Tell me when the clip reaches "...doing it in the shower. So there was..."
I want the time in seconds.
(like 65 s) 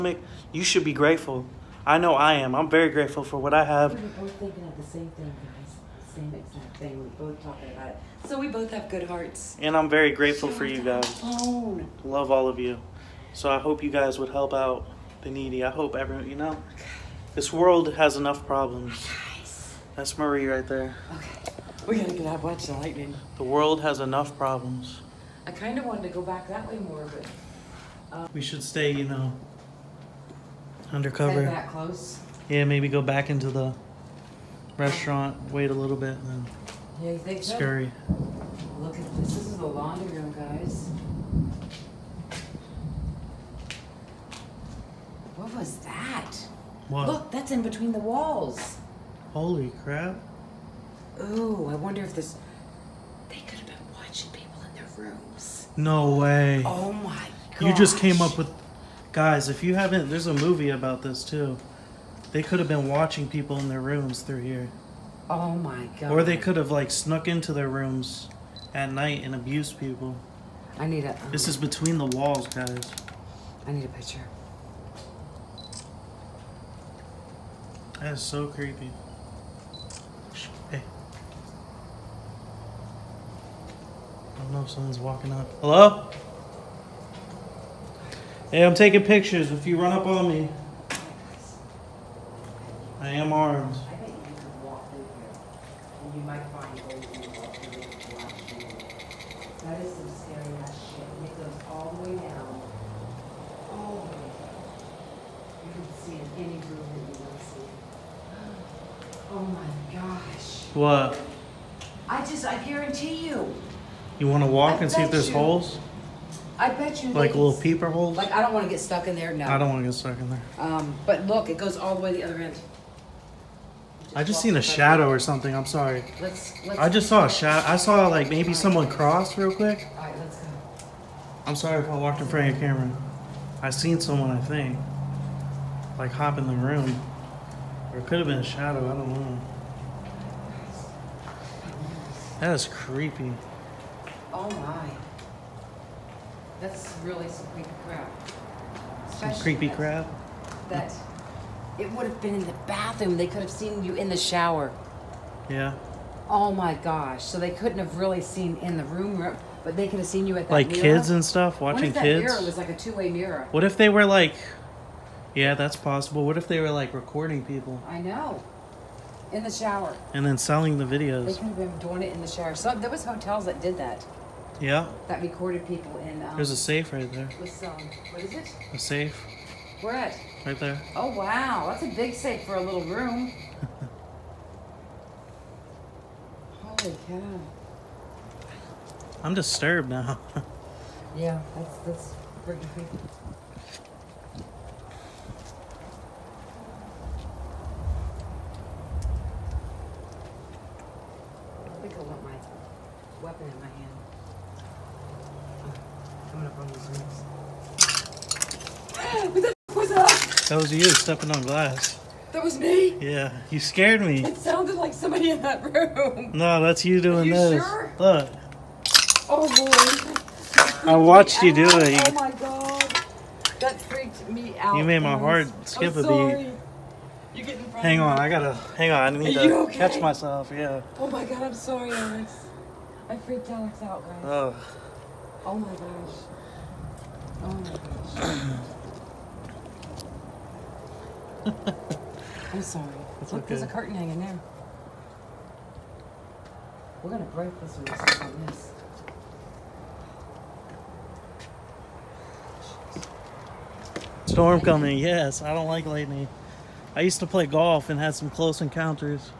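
171 s.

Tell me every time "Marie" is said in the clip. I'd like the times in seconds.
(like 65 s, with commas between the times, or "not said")
20 s.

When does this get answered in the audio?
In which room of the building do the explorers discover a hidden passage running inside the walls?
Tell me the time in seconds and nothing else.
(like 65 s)
39 s.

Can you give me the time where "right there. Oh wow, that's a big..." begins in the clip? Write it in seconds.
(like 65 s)
180 s.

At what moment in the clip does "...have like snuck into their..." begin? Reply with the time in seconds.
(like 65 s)
66 s.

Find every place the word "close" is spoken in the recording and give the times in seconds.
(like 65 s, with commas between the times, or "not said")
31 s, 258 s.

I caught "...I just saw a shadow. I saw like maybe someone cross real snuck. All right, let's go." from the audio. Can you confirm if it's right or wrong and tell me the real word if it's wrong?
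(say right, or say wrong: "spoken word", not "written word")
wrong: "quick", not "snuck".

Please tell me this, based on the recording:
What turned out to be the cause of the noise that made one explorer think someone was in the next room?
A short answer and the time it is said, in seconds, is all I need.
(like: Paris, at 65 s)
Stepping on glass, at 210 s.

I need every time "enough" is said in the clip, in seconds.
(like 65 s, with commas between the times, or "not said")
18 s, 23 s.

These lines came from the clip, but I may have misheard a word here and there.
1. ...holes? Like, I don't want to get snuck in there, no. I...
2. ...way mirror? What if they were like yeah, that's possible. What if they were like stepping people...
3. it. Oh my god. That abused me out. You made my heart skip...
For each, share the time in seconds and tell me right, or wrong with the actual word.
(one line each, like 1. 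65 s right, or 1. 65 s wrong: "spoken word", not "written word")
1. 117 s wrong: "stuck", not "snuck"
2. 162 s wrong: "recording", not "stepping"
3. 221 s wrong: "freaked", not "abused".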